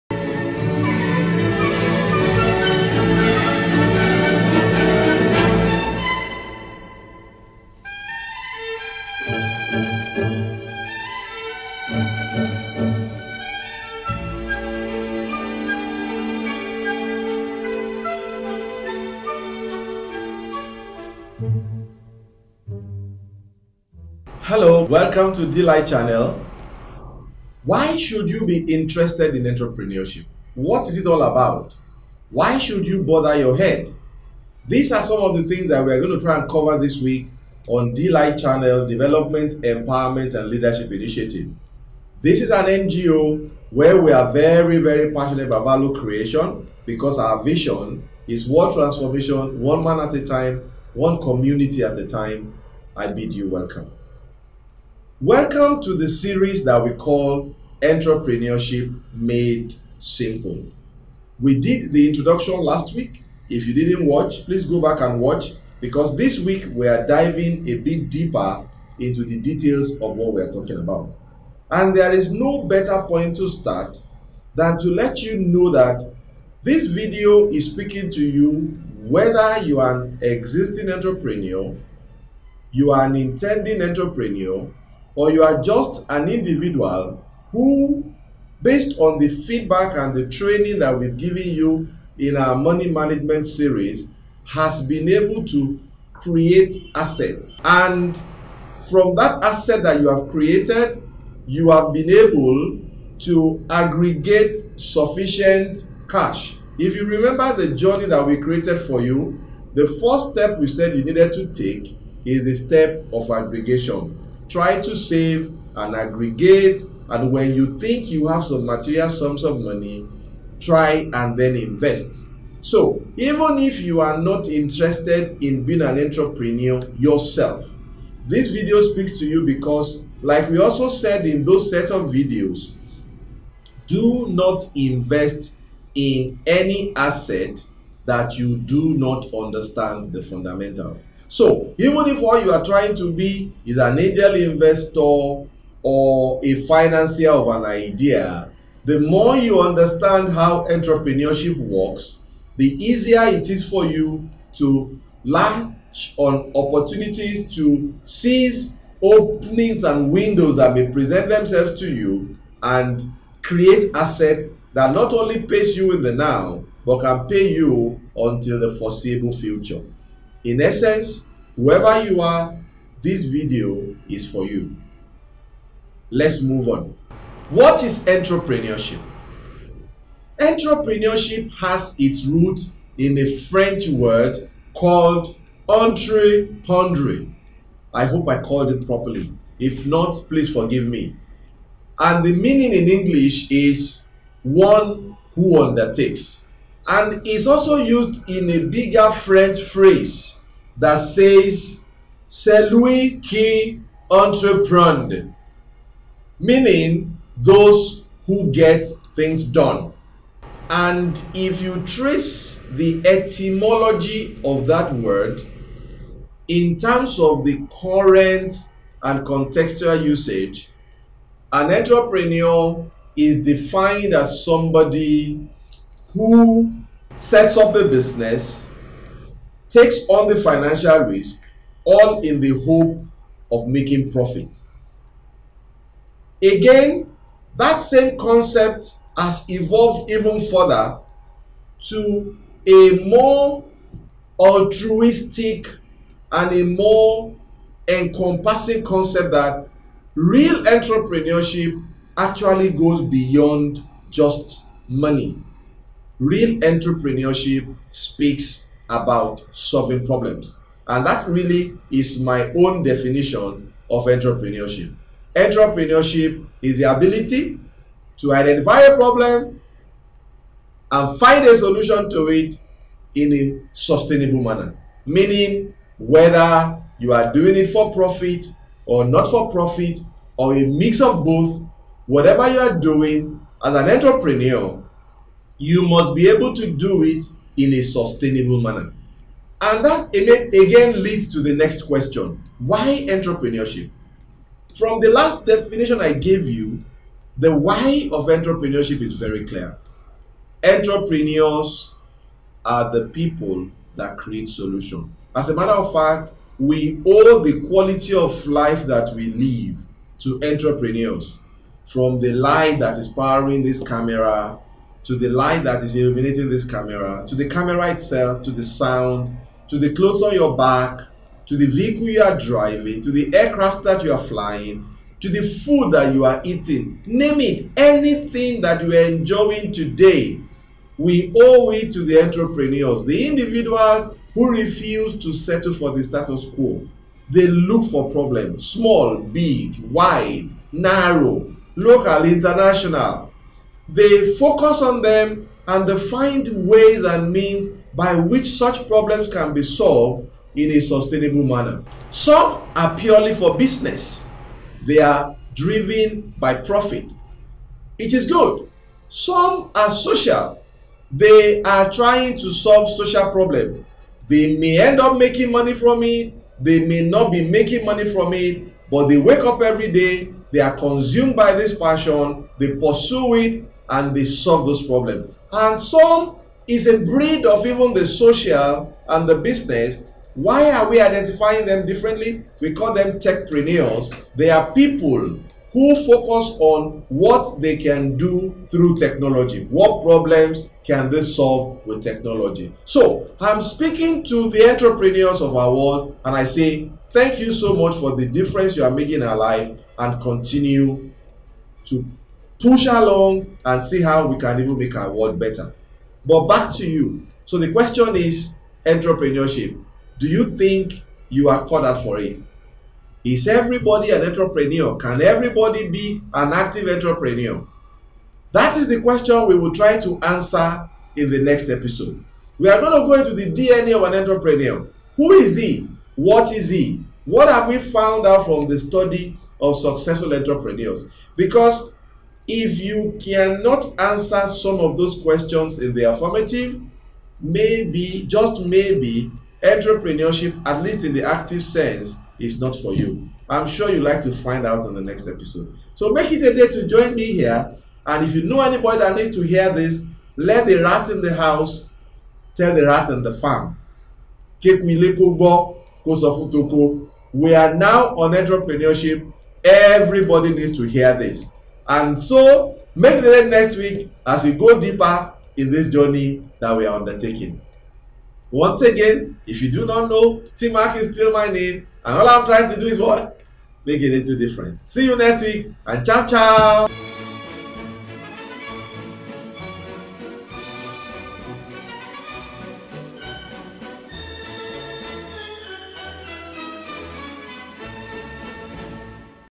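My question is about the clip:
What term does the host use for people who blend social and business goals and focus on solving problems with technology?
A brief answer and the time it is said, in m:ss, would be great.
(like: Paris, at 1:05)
techpreneurs, at 6:23.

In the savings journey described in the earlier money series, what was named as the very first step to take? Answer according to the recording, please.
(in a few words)
aggregation.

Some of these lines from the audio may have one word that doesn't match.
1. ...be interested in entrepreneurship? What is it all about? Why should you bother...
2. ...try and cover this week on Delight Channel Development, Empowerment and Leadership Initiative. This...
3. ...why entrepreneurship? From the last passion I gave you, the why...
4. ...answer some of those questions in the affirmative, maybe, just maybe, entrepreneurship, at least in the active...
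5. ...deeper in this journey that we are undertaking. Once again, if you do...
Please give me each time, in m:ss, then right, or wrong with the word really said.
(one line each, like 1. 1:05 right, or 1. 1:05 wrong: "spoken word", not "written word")
1. 0:28 right
2. 0:36 right
3. 4:52 wrong: "definition", not "passion"
4. 7:13 right
5. 7:44 right.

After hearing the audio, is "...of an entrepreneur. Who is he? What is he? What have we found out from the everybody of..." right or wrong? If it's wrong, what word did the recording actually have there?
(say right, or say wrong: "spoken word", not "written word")
wrong: "study", not "everybody".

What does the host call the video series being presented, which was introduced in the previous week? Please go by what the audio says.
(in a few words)
Entrepreneurship Made Simple.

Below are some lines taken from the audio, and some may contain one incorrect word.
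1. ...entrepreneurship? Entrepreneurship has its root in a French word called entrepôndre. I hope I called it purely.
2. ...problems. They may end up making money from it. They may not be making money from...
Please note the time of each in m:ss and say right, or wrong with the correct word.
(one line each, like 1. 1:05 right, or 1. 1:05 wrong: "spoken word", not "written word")
1. 2:58 wrong: "properly", not "purely"
2. 6:03 right.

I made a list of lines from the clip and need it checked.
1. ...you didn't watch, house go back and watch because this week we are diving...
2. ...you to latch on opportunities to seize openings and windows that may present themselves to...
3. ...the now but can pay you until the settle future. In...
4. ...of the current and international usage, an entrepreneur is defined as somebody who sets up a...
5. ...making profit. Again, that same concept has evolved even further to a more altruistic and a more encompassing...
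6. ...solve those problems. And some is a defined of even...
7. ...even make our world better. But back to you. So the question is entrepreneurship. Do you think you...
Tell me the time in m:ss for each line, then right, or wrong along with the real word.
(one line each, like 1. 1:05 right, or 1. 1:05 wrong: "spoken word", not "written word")
1. 1:03 wrong: "please", not "house"
2. 2:33 right
3. 2:46 wrong: "foreseeable", not "settle"
4. 3:37 wrong: "contextual", not "international"
5. 3:53 right
6. 6:14 wrong: "breed", not "defined"
7. 6:44 right.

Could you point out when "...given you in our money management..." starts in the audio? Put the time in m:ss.
1:31.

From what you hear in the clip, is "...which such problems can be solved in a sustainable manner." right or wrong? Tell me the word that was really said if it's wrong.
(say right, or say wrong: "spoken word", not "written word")
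right.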